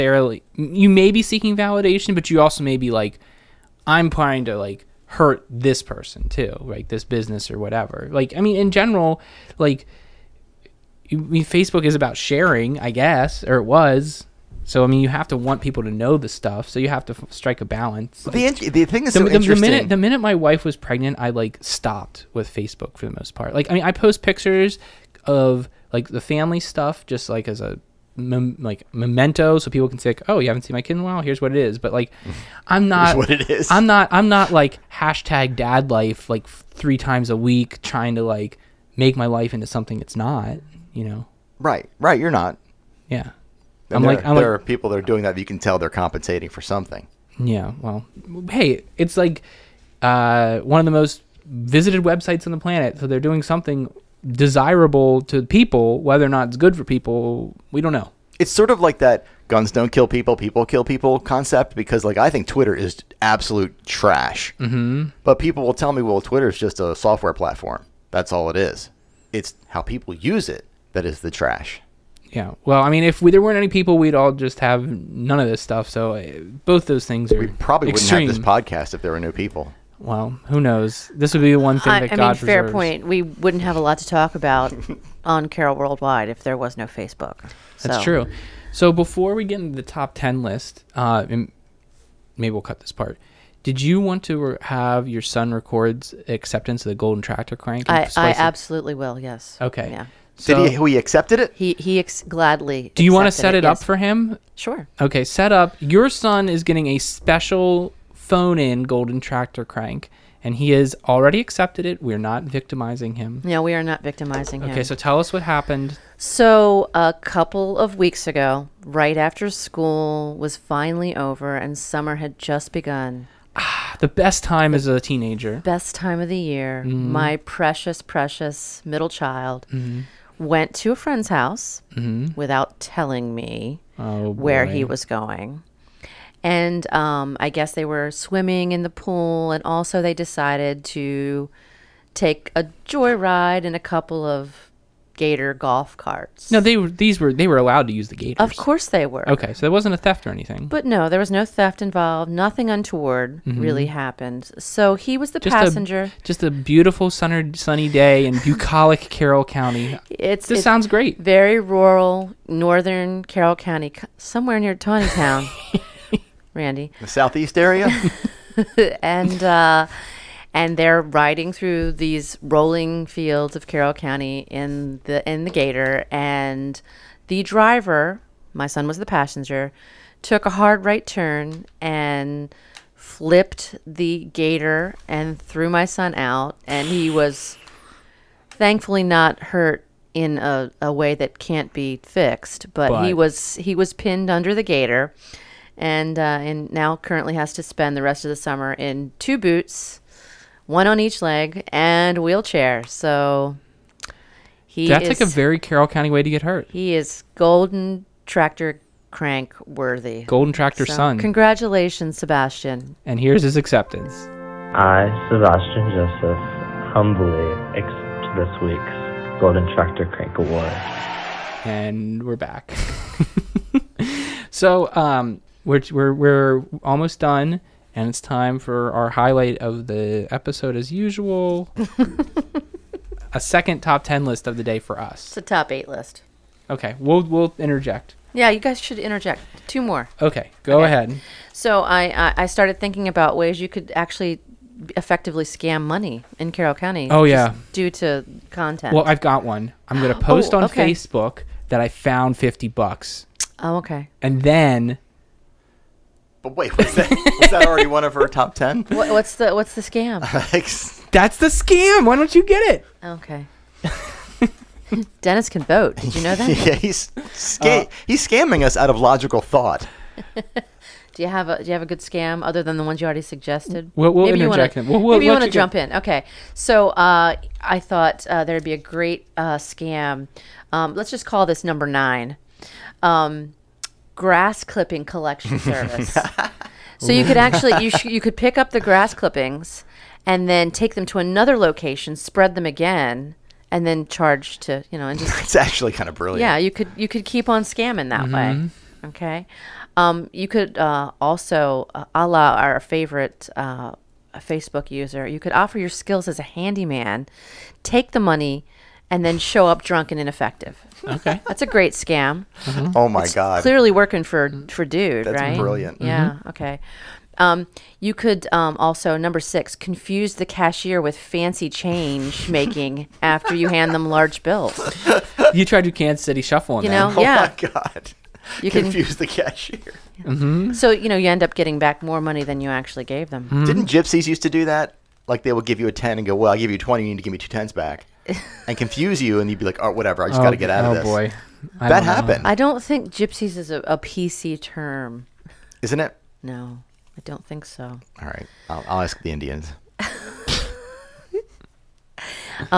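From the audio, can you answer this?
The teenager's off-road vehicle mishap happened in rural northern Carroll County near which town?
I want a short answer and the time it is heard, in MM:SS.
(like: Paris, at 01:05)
Taneytown, at 02:44.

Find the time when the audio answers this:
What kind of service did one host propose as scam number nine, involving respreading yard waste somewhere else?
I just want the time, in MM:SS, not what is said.
04:44.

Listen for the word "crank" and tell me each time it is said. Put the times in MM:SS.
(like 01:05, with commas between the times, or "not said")
01:37, 01:49, 03:29, 03:40.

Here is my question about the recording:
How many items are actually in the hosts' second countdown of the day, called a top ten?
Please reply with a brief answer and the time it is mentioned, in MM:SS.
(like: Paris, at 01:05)
8, at 03:55.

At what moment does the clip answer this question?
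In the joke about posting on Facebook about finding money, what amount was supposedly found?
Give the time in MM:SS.
04:12.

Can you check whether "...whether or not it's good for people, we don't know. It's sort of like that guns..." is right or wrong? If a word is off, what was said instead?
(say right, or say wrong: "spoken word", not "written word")
right.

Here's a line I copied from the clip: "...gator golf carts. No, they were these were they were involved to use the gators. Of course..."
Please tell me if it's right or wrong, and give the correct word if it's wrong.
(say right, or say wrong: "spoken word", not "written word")
wrong: "allowed", not "involved".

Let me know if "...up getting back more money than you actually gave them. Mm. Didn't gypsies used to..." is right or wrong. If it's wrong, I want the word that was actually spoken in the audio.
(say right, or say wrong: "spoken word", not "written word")
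right.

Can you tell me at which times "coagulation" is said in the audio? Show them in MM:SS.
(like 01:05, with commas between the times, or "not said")
not said.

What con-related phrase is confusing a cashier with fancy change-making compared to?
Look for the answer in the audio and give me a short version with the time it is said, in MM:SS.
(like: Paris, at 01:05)
Kansas City shuffle, at 05:25.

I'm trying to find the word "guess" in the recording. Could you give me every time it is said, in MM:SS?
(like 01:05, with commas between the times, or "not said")
00:12, 02:17.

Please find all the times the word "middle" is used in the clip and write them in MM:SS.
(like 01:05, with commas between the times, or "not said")
02:08.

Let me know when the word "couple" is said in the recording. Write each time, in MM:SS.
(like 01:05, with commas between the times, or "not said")
01:57, 02:23.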